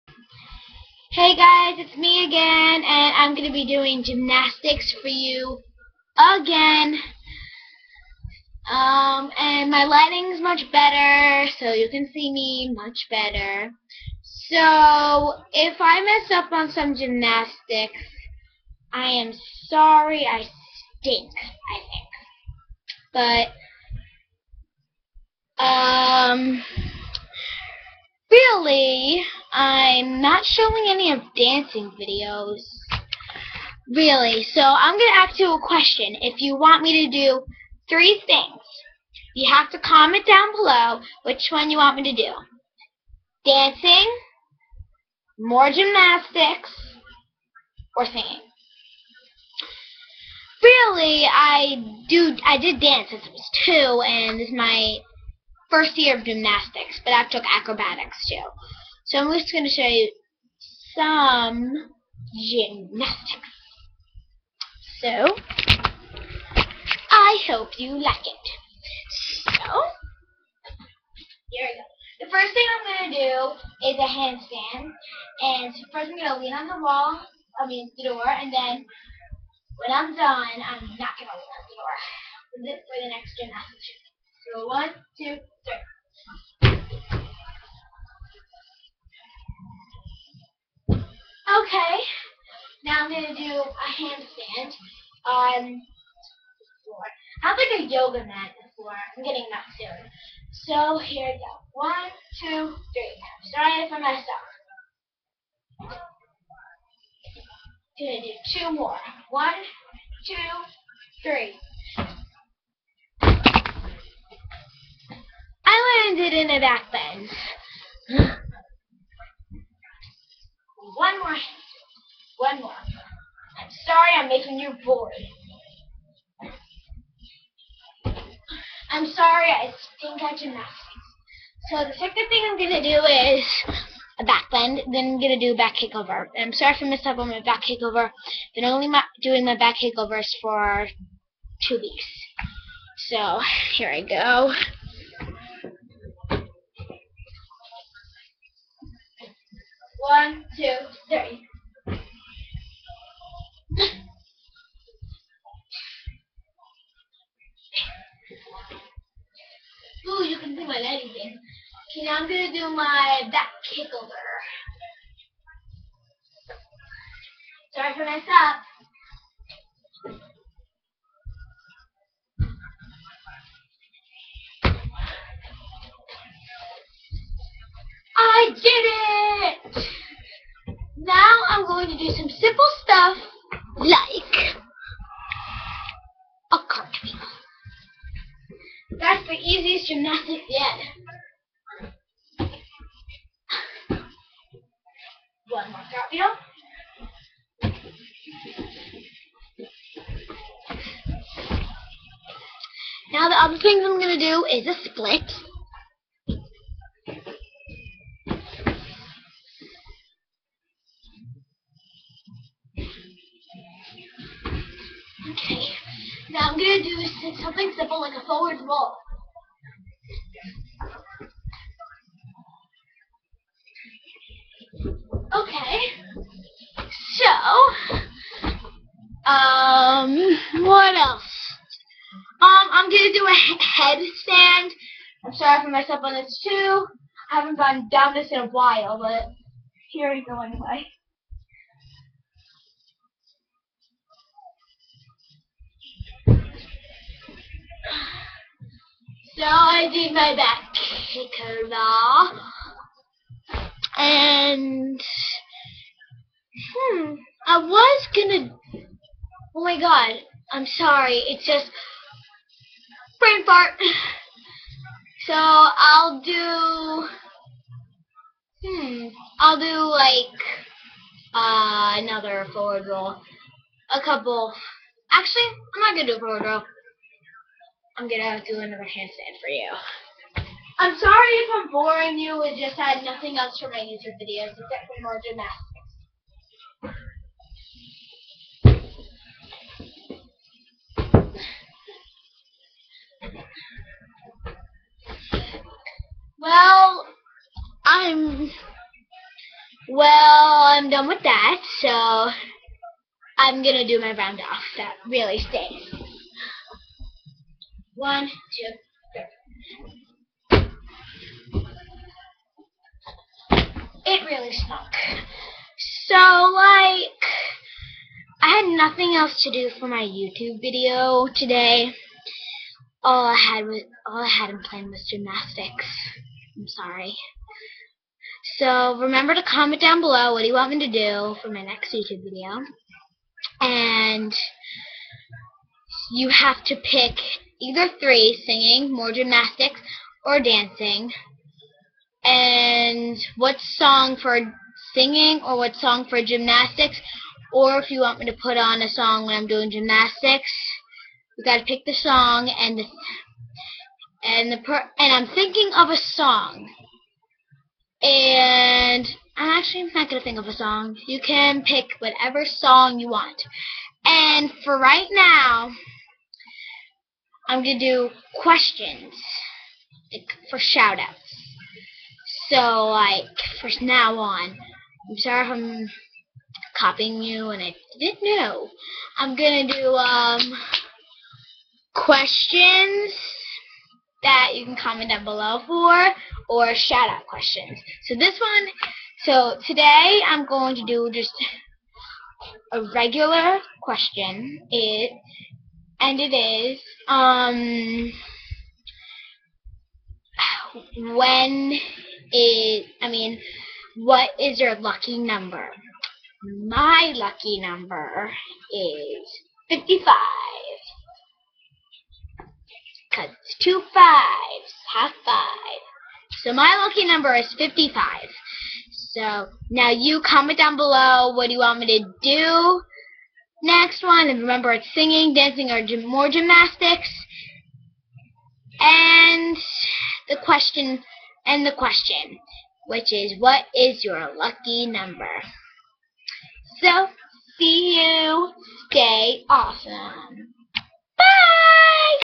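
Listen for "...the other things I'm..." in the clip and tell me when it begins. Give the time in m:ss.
3:23.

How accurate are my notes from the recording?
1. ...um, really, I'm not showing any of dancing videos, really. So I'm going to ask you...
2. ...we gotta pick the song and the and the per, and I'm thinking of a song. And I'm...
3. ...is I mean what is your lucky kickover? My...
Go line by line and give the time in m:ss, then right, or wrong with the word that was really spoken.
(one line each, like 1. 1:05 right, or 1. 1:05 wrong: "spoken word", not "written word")
1. 0:25 right
2. 5:51 right
3. 6:42 wrong: "number", not "kickover".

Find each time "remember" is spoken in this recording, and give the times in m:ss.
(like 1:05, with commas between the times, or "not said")
5:29, 7:04.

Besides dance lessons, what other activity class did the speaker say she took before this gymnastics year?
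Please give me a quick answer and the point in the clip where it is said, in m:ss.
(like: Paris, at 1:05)
acrobatics, at 0:57.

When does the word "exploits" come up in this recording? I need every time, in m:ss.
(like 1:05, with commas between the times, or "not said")
not said.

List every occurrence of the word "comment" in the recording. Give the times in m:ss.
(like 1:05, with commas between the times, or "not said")
0:39, 5:29, 6:24, 7:00.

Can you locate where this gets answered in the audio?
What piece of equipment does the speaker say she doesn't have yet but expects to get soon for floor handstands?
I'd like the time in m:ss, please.
1:37.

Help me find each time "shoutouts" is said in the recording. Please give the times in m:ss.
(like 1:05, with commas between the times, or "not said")
6:10, 6:26.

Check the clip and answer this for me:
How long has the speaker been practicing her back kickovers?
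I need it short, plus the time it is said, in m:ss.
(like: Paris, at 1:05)
2 weeks, at 2:21.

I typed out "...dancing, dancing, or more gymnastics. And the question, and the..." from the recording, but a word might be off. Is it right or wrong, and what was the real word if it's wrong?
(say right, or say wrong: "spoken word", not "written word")
wrong: "singing", not "dancing".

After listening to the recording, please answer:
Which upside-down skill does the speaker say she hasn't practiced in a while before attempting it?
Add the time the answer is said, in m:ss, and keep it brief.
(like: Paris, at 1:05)
headstand, at 3:53.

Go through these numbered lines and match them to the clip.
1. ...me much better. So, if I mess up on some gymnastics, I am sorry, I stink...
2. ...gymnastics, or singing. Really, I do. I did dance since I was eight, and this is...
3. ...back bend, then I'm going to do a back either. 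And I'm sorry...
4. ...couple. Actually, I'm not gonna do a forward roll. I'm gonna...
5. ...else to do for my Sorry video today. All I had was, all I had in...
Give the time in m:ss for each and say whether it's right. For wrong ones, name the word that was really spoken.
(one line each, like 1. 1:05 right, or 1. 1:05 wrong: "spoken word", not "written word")
1. 0:12 right
2. 0:45 wrong: "two", not "eight"
3. 2:14 wrong: "kickover", not "either"
4. 4:34 right
5. 5:19 wrong: "YouTube", not "Sorry".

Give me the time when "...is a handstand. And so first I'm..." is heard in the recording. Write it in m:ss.
1:13.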